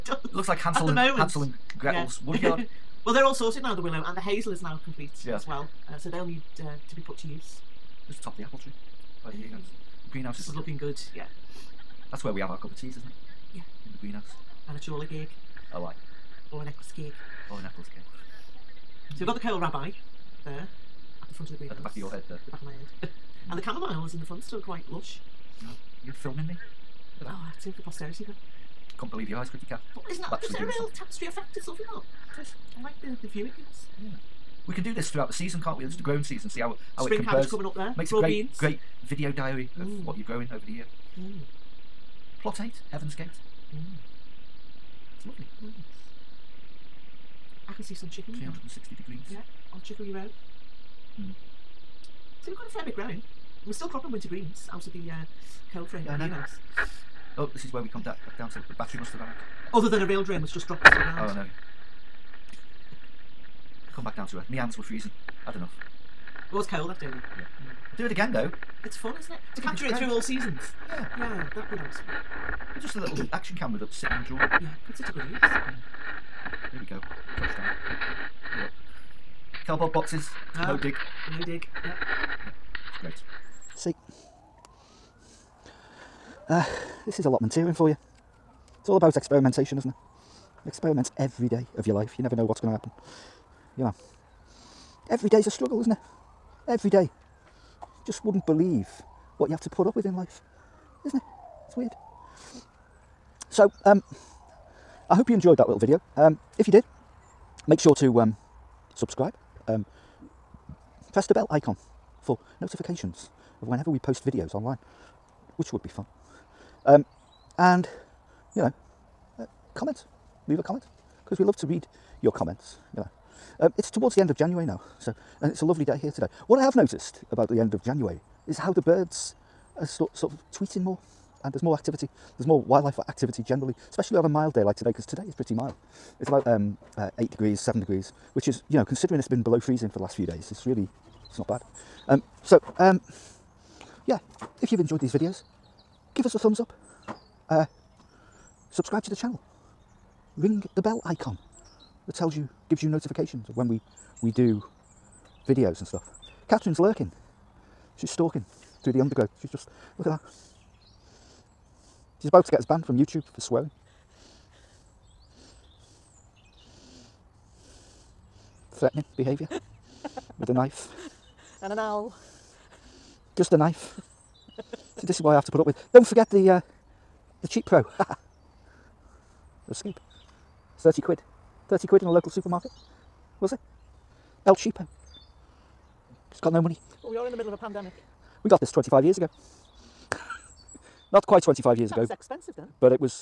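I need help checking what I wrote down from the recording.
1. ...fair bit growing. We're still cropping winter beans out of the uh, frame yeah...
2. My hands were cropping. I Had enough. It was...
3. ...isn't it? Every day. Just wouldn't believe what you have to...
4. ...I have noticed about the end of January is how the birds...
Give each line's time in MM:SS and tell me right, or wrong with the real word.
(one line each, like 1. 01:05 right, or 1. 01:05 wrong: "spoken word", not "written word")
1. 00:52 wrong: "greens", not "beans"
2. 01:04 wrong: "freezing", not "cropping"
3. 01:35 right
4. 02:06 right.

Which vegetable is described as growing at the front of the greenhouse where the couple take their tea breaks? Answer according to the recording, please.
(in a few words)
kohlrabi.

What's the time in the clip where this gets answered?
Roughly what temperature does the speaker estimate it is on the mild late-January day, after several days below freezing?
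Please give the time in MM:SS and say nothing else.
02:17.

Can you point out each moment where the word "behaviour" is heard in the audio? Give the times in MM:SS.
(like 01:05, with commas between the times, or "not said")
02:49.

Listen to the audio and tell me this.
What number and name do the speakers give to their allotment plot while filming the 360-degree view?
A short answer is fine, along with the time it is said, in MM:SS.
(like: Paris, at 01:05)
Plot 8, Heaven's Gate, at 00:42.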